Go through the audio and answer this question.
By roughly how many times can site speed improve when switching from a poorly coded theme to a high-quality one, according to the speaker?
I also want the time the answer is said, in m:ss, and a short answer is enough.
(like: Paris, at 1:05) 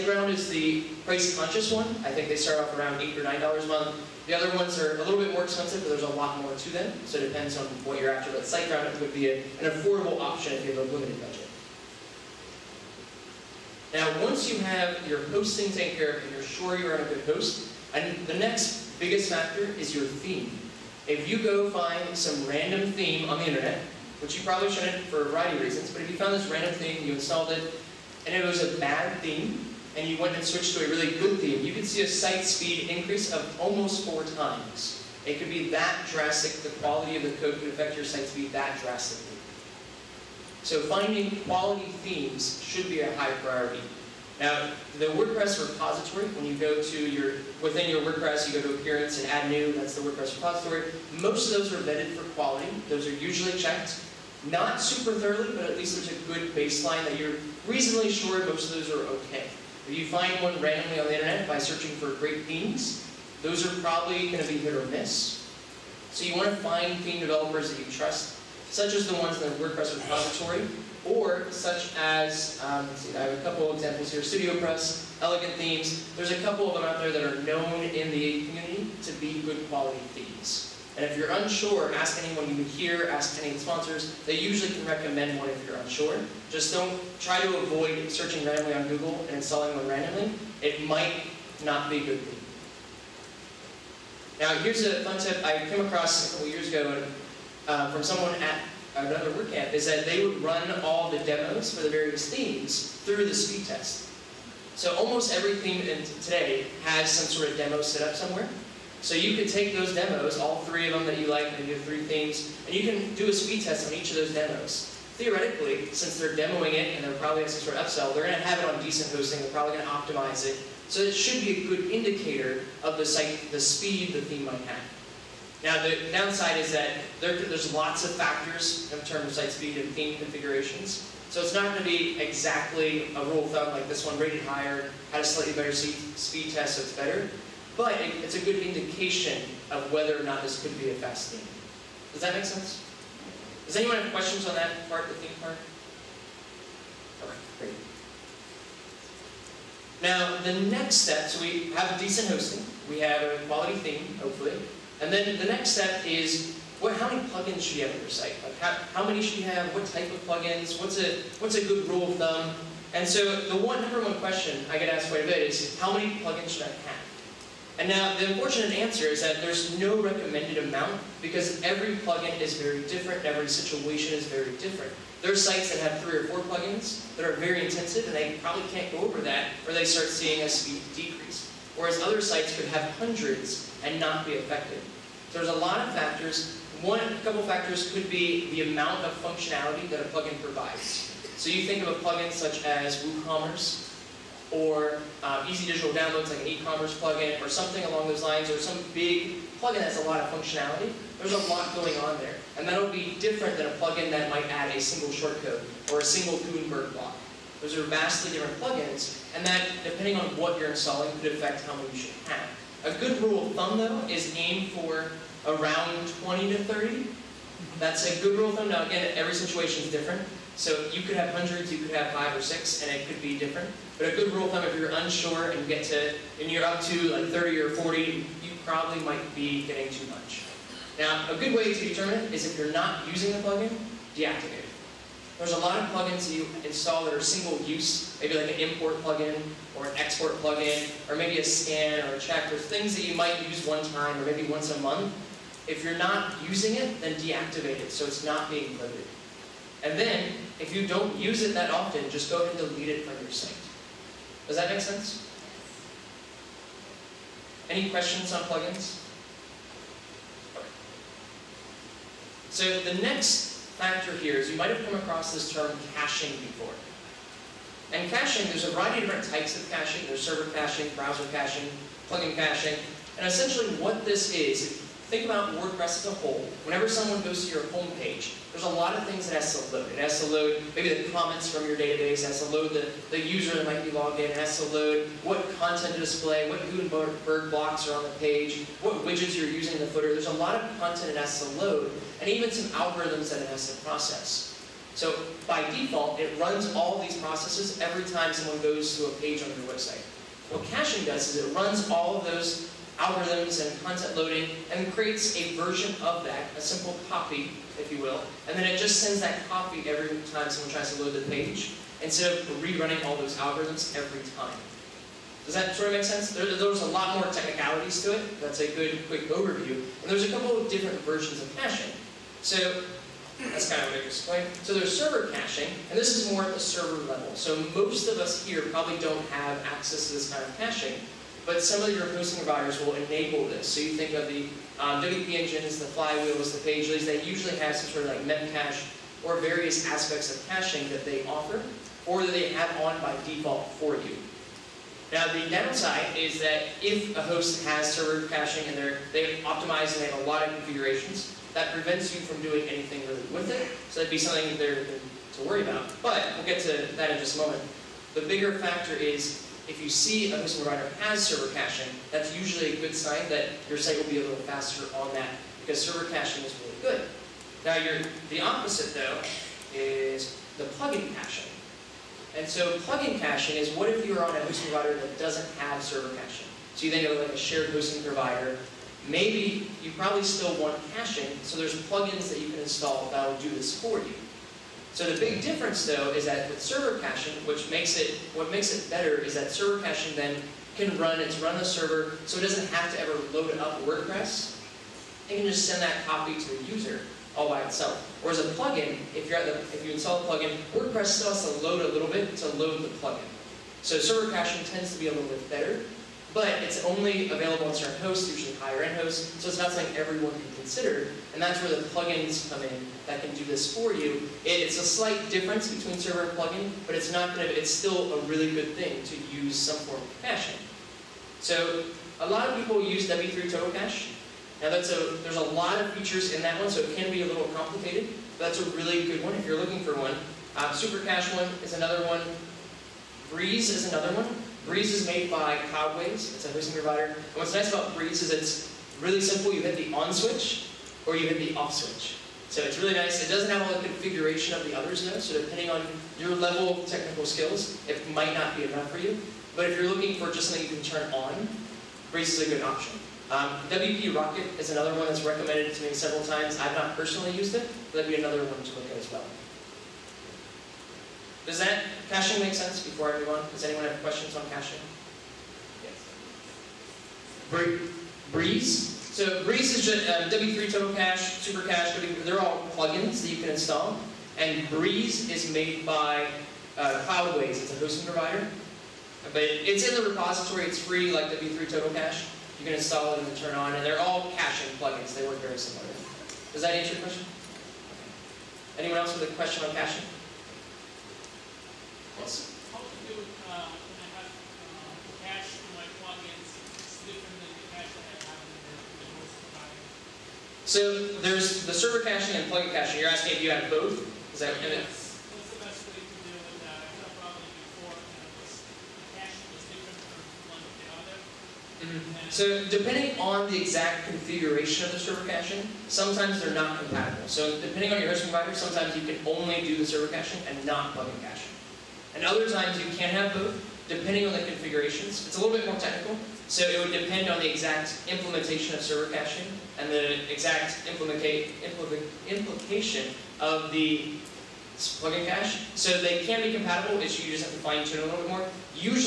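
4 times, at 0:33.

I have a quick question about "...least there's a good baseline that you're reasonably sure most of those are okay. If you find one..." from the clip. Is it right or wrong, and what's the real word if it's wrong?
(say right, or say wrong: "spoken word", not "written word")
right.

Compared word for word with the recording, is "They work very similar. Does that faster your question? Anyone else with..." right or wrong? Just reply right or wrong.
wrong.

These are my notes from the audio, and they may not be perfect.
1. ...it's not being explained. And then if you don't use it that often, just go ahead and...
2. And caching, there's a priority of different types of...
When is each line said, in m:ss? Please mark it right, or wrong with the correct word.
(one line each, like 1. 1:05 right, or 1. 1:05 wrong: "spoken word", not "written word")
1. 4:08 wrong: "loaded", not "explained"
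2. 4:27 wrong: "variety", not "priority".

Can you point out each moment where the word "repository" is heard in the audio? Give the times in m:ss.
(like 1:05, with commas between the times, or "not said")
0:45, 0:50, 1:09, 8:00.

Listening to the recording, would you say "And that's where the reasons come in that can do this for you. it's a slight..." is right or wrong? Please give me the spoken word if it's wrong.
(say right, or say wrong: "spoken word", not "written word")
wrong: "plugins", not "reasons".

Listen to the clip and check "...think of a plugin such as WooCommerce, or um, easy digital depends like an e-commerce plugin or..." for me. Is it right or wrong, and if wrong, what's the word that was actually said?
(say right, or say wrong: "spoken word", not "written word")
wrong: "downloads", not "depends".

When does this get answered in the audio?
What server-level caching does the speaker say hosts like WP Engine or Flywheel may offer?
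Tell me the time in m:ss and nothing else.
5:38.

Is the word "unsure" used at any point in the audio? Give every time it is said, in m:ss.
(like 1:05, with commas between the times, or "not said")
1:21, 1:25, 3:44.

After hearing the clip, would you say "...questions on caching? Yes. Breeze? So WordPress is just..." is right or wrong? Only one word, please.
wrong.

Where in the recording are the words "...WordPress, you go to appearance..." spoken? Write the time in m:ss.
0:48.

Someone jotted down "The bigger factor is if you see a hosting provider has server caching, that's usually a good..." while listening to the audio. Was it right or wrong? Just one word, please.
right.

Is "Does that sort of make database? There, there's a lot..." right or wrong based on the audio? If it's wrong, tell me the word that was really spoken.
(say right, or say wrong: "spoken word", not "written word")
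wrong: "sense", not "database".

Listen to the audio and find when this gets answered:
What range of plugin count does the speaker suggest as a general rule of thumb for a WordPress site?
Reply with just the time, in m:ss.
3:35.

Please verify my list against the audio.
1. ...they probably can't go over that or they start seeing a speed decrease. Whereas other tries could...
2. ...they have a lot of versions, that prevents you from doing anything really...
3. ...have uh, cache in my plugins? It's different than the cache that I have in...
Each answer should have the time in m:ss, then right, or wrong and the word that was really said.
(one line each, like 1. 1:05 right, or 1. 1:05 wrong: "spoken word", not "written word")
1. 2:58 wrong: "sites", not "tries"
2. 5:50 wrong: "configurations", not "versions"
3. 8:14 right.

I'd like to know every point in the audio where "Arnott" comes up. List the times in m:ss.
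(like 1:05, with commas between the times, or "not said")
not said.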